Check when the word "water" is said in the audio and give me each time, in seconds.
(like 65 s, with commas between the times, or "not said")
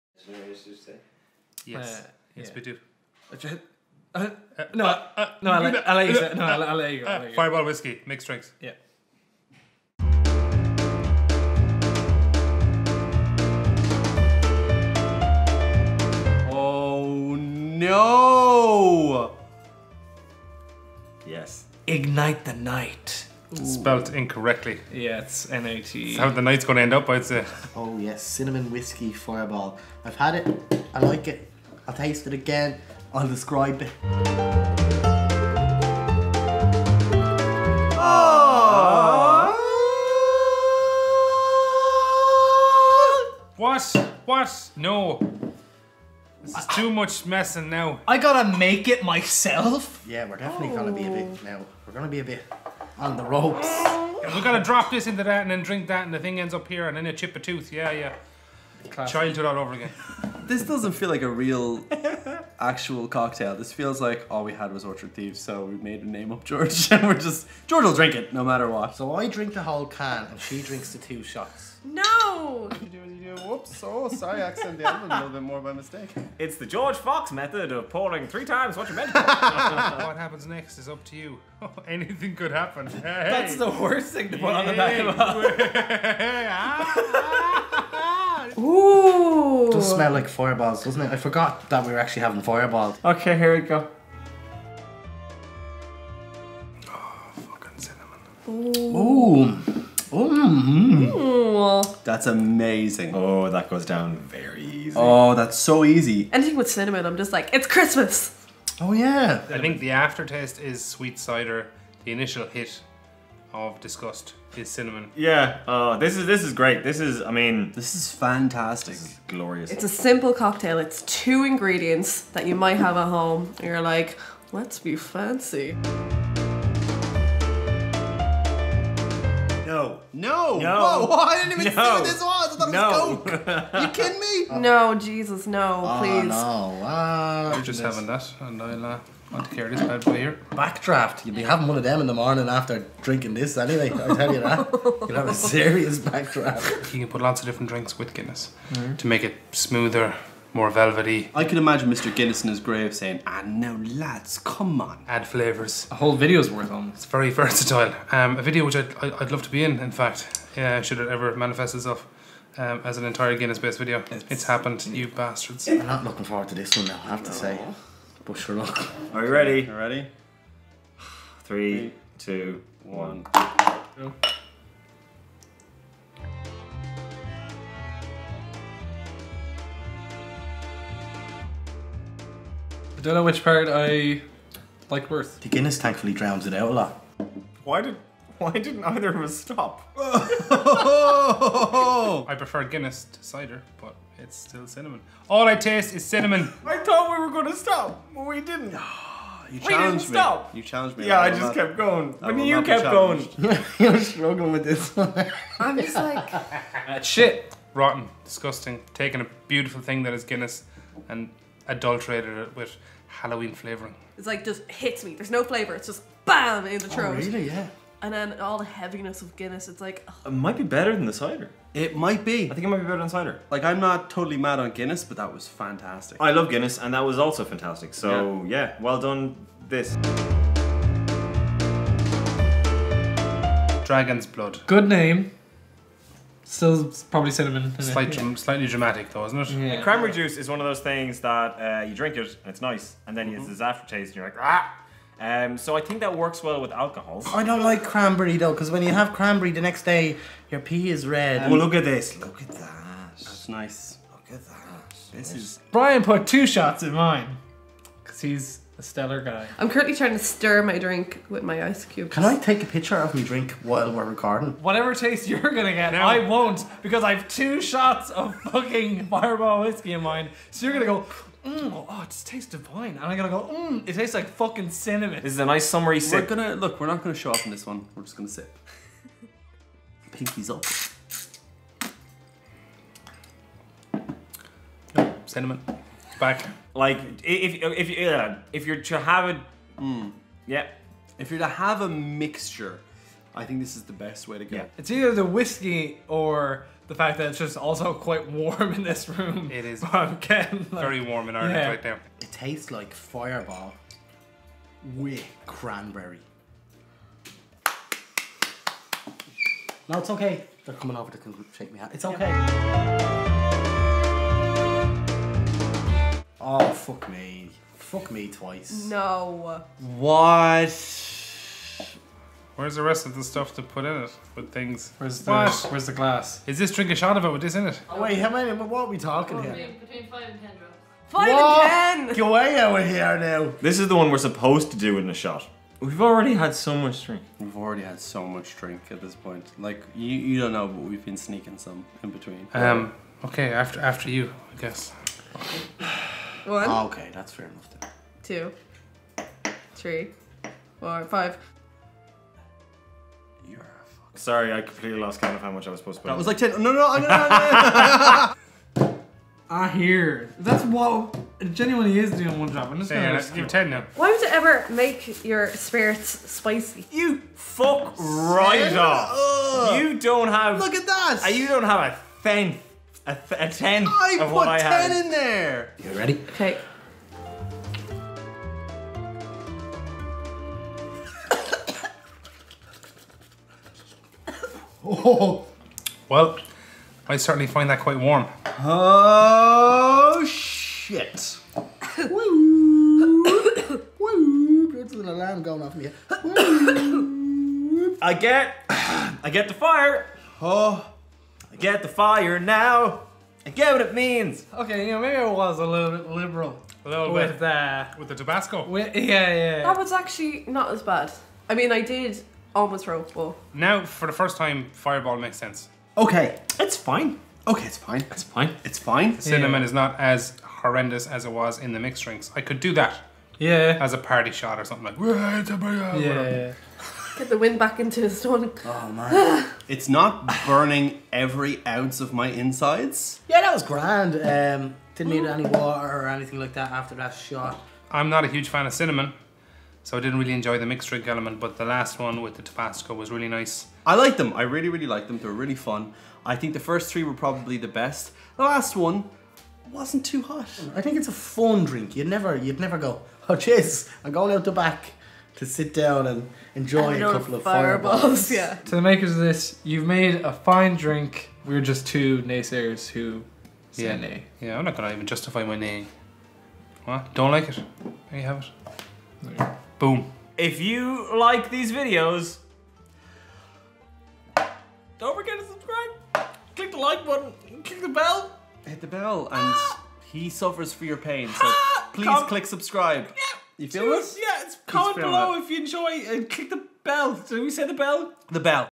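435 s.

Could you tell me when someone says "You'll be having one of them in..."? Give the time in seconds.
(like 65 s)
141 s.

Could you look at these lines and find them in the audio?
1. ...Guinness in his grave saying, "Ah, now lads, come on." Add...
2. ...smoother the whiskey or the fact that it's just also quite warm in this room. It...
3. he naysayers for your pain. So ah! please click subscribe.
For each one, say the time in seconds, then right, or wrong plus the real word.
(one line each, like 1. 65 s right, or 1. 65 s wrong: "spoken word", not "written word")
1. 152 s right
2. 294 s wrong: "either", not "smoother"
3. 480 s wrong: "suffers", not "naysayers".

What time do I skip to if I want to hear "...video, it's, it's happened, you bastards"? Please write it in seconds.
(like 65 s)
163 s.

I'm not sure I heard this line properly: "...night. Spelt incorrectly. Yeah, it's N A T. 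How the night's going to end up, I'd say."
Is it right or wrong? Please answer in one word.
right.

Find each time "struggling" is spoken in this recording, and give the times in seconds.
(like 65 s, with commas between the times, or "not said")
203 s.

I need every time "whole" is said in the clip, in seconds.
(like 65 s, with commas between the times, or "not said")
69 s, 155 s.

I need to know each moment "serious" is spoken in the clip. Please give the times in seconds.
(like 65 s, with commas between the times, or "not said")
145 s.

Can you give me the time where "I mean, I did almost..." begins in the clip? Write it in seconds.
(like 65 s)
411 s.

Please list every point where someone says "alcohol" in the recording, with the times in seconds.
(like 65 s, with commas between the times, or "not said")
246 s.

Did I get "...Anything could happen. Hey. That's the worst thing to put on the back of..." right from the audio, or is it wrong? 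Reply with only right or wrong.
right.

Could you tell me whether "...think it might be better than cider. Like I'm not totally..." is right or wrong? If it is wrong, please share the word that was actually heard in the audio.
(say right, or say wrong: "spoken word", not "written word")
right.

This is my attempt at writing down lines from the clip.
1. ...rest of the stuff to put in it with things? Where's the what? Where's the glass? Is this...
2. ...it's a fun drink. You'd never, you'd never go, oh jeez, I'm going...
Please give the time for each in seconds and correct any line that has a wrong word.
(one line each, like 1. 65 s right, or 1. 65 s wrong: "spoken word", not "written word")
1. 322 s right
2. 450 s right.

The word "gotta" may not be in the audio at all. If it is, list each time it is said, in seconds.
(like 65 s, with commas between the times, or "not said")
48 s, 54 s.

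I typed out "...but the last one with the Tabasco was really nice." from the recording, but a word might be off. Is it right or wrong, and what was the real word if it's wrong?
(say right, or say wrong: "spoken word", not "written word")
right.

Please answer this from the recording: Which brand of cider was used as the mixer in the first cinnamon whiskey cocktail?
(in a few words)
Orchard Thieves.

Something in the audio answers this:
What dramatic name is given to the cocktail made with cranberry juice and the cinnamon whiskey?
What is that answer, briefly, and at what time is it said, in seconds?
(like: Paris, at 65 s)
Dragon's Blood, at 233 s.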